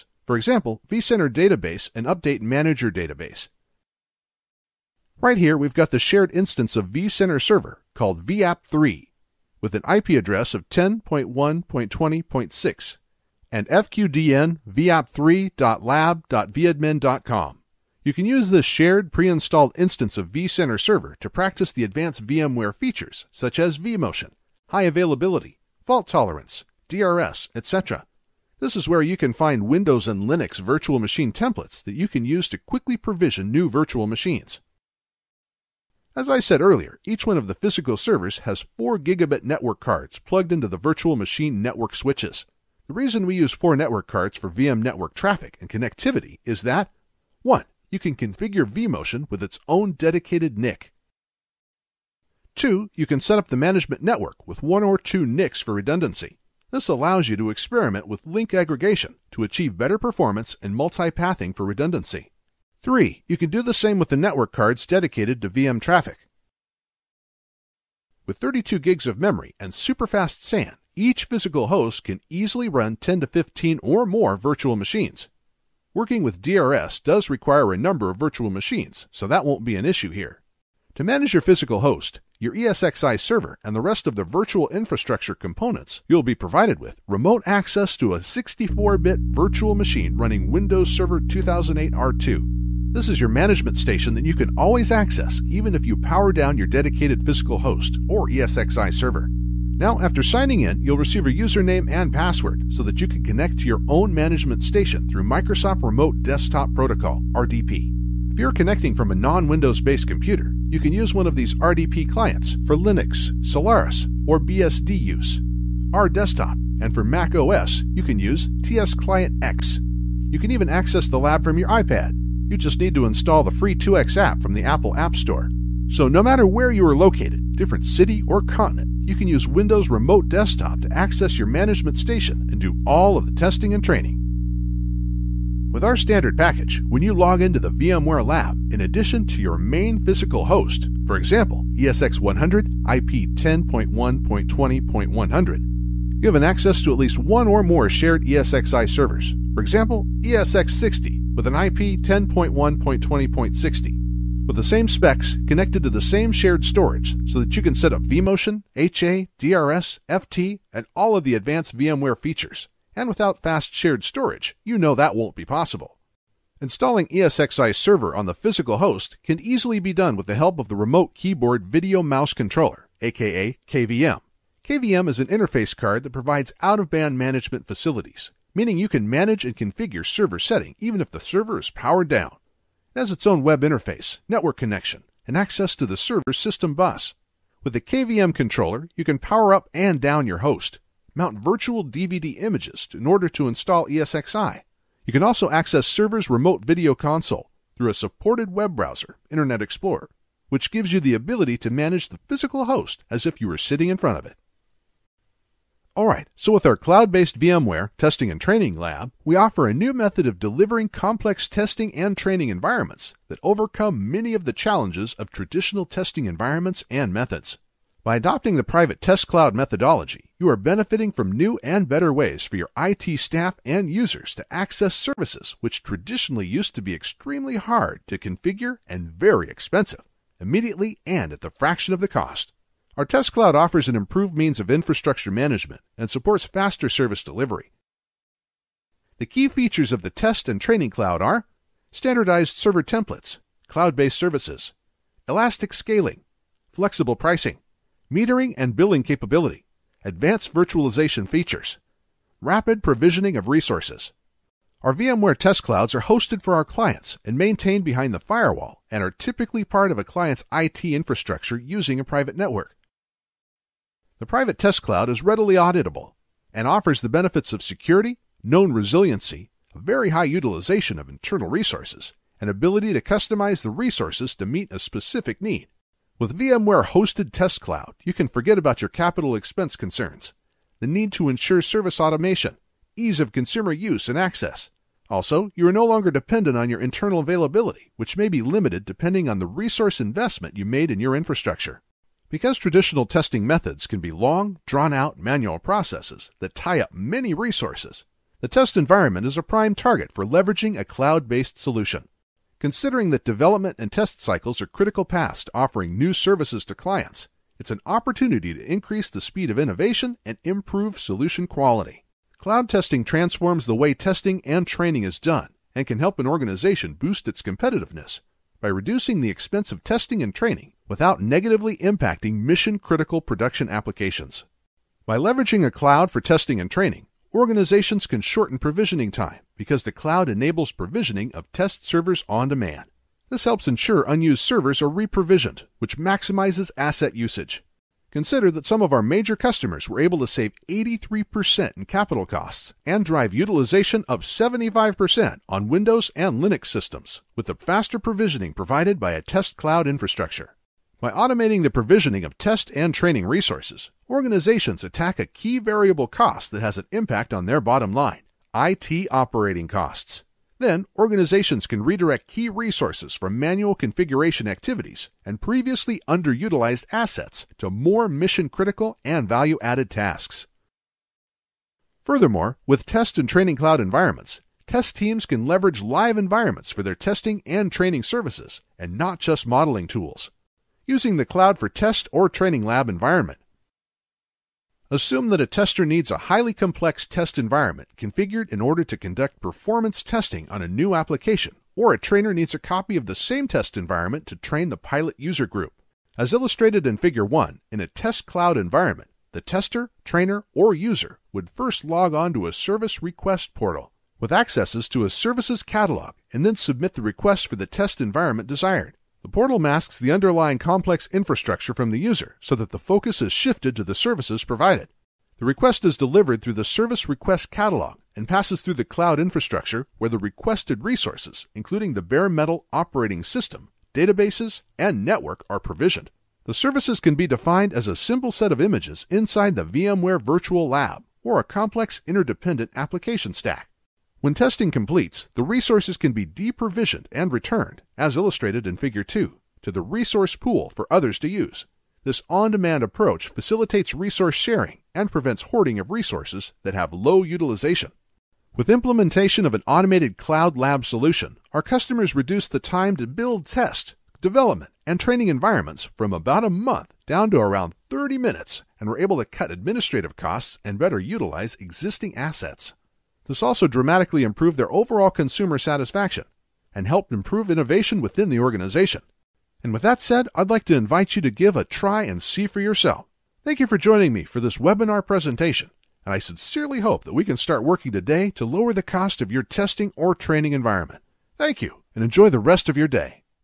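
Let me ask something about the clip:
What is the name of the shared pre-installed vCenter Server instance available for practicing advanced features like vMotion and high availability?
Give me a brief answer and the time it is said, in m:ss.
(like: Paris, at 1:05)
VAP3, at 0:08.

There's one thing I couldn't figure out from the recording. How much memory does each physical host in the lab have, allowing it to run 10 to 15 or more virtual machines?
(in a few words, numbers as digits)
32 gigs.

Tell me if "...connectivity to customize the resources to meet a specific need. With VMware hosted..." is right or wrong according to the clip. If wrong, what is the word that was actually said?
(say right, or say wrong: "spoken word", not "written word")
wrong: "ability", not "connectivity".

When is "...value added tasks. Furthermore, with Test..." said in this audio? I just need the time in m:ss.
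6:09.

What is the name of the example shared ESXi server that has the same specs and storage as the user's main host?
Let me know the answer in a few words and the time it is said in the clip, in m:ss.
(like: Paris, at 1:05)
ESX60, at 2:30.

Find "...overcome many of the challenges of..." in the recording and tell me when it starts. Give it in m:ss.
3:33.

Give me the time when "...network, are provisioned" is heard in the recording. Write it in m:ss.
7:05.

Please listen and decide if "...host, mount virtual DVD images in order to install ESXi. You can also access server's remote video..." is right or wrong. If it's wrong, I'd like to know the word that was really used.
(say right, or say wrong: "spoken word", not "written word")
right.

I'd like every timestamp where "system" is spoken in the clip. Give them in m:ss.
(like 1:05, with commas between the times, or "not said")
3:06, 5:46, 7:03.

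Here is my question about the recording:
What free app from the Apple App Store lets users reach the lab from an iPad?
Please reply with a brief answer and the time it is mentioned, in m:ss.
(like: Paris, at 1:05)
2x, at 2:03.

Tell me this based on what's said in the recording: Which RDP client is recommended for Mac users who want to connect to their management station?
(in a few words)
TS Client X.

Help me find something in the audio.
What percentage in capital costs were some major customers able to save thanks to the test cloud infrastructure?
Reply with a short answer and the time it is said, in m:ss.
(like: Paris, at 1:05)
83%, at 5:40.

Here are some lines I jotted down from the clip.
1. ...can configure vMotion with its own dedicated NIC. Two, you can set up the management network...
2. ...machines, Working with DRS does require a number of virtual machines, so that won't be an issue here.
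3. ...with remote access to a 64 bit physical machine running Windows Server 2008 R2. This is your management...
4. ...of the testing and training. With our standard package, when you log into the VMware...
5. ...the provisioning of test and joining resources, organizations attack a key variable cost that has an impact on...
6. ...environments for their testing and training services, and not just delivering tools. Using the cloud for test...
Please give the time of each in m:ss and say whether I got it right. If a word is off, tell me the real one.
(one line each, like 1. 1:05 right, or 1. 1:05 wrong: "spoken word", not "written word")
1. 0:47 right
2. 1:14 right
3. 1:26 wrong: "virtual", not "physical"
4. 2:13 right
5. 5:51 wrong: "training", not "joining"
6. 6:16 wrong: "modeling", not "delivering".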